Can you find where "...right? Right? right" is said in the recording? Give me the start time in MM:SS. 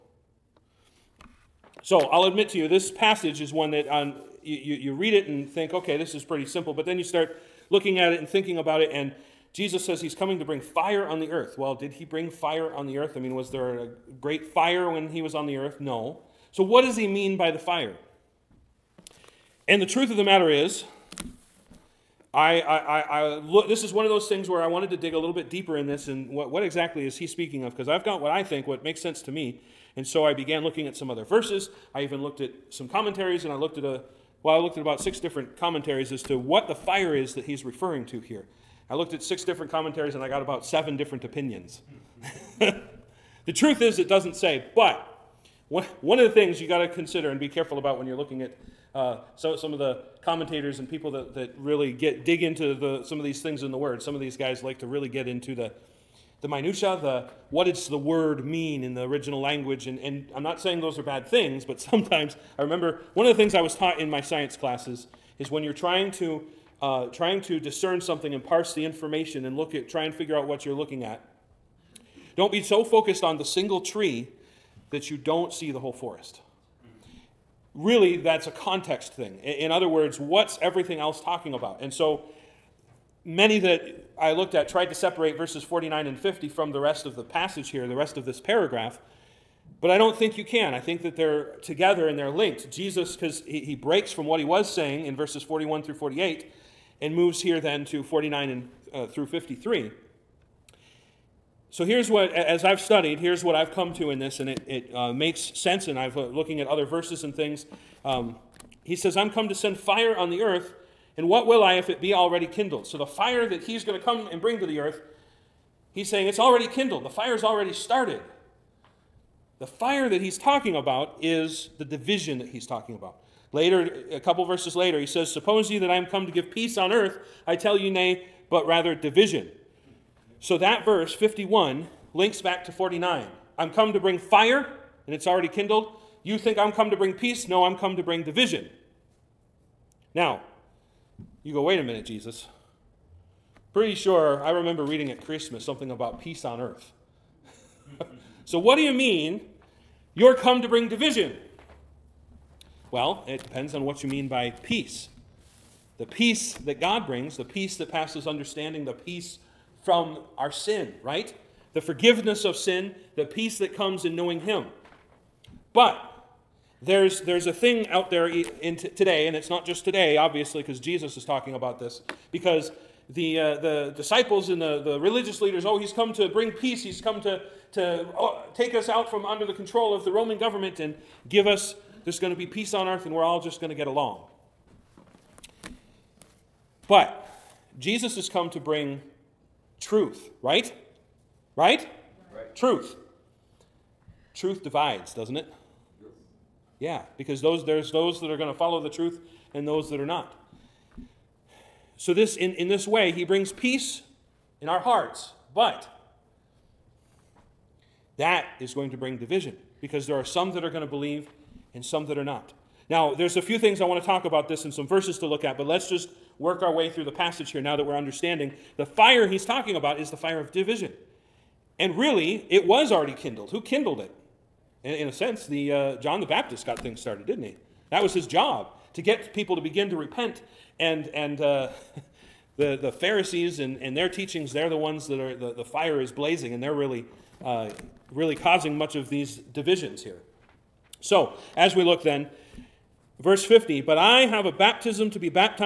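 03:10.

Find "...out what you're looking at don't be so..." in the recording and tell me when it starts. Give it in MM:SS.
01:10.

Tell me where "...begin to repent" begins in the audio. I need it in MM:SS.
03:49.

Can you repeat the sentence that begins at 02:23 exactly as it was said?
Pretty sure I remember reading at Christmas something about peace on earth.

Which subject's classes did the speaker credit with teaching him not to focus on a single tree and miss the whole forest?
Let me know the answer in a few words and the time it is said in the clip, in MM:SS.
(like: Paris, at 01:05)
Science, at 01:04.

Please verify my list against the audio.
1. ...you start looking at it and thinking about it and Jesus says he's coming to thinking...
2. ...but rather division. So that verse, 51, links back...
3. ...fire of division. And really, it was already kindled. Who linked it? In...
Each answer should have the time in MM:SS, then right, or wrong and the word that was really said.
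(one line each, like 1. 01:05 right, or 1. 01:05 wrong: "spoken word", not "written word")
1. 00:06 wrong: "bring", not "thinking"
2. 02:08 right
3. 03:40 wrong: "kindled", not "linked".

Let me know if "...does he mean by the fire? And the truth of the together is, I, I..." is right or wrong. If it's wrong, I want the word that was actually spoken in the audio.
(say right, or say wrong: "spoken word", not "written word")
wrong: "matter", not "together".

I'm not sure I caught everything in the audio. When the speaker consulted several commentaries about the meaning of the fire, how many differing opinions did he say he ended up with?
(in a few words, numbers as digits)
7.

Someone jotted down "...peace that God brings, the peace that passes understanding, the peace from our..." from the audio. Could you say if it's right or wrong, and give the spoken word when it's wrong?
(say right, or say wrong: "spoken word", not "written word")
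right.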